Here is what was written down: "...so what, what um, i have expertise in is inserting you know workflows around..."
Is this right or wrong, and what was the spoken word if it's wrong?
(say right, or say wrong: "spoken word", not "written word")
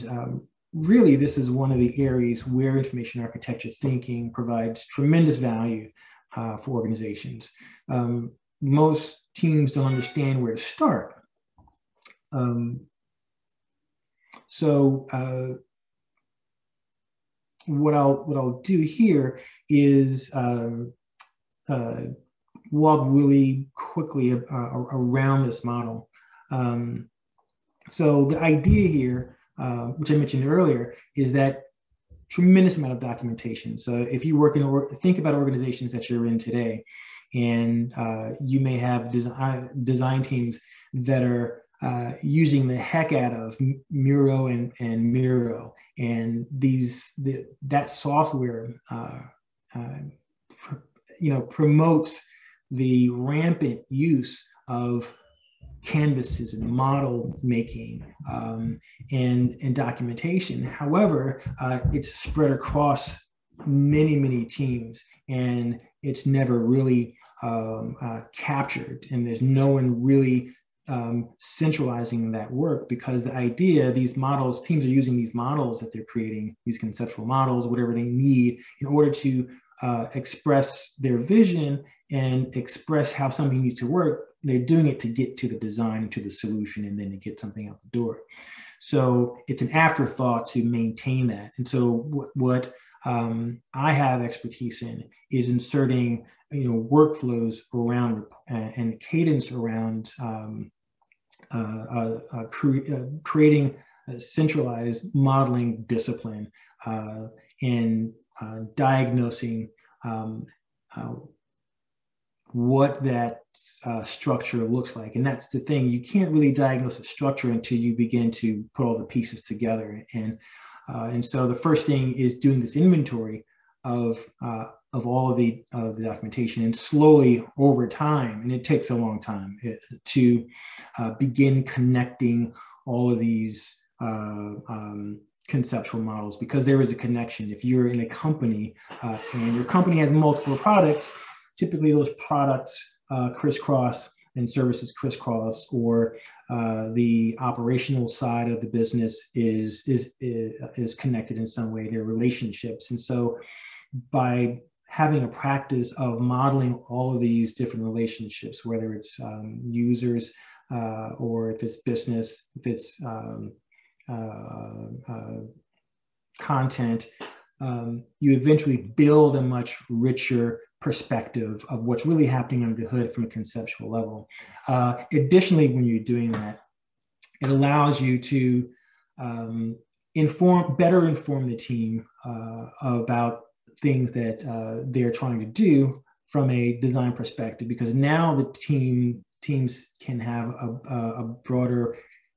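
right.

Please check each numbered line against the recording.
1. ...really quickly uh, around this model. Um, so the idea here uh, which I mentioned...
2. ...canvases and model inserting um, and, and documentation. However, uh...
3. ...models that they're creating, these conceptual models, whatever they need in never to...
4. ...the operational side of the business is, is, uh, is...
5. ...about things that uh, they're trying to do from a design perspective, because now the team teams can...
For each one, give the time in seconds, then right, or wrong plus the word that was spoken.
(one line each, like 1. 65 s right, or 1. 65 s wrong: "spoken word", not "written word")
1. 23 s right
2. 55 s wrong: "making", not "inserting"
3. 75 s wrong: "order", not "never"
4. 146 s right
5. 182 s right.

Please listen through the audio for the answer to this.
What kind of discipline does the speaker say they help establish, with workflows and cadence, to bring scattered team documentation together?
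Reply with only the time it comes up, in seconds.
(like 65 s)
104 s.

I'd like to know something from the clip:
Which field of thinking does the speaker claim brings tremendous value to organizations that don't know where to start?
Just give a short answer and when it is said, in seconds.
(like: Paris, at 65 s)
information architecture, at 2 s.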